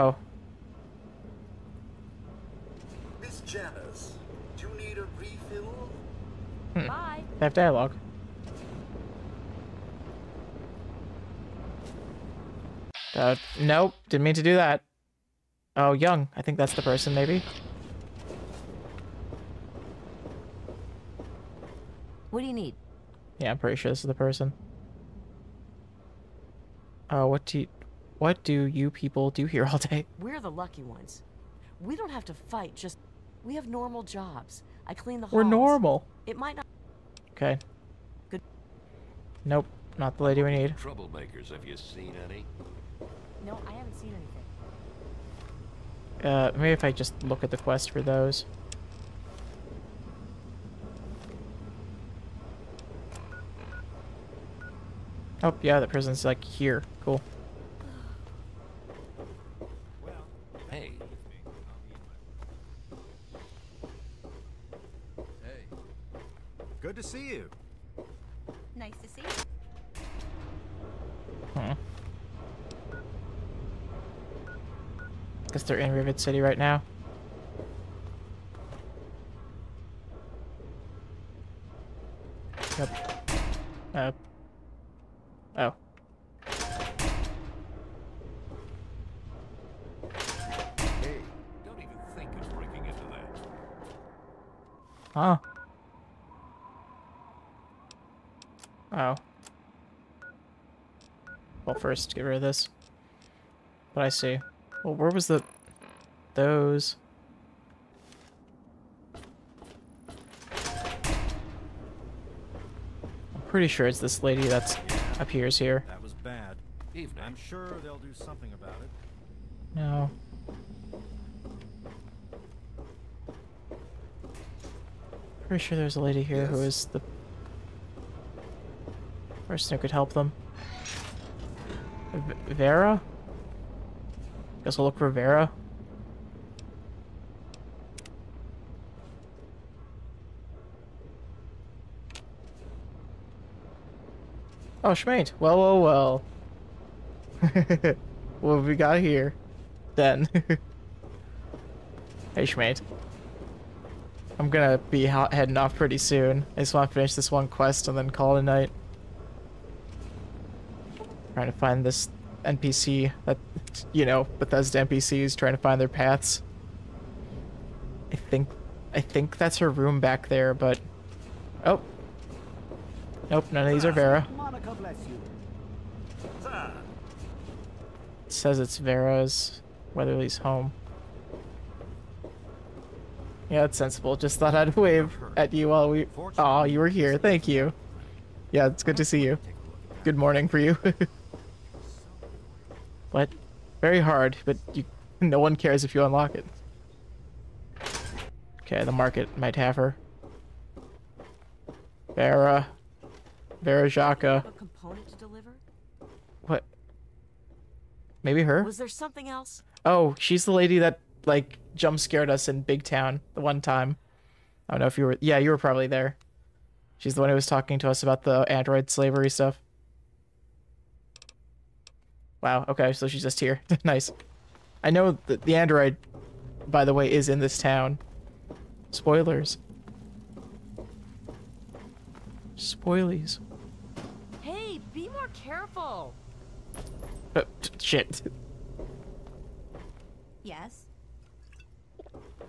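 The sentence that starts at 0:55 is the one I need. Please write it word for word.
Oh, yeah, the prison's like here.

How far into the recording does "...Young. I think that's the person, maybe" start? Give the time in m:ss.
0:15.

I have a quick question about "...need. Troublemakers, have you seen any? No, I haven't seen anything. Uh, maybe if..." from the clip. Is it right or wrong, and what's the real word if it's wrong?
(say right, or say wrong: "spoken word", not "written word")
right.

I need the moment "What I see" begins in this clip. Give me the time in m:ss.
1:43.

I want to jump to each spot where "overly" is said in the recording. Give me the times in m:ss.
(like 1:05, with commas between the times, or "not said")
not said.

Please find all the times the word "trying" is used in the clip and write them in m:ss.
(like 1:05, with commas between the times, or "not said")
2:41, 2:45.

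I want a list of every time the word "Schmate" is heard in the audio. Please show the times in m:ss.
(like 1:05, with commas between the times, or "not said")
2:24, 2:32.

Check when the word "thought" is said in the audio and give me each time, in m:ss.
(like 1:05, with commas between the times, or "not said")
3:04.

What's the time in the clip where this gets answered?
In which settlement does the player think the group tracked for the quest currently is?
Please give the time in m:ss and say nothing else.
1:15.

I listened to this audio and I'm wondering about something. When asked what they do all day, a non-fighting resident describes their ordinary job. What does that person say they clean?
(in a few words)
The halls.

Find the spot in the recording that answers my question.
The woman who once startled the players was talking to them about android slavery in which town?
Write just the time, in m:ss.
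3:32.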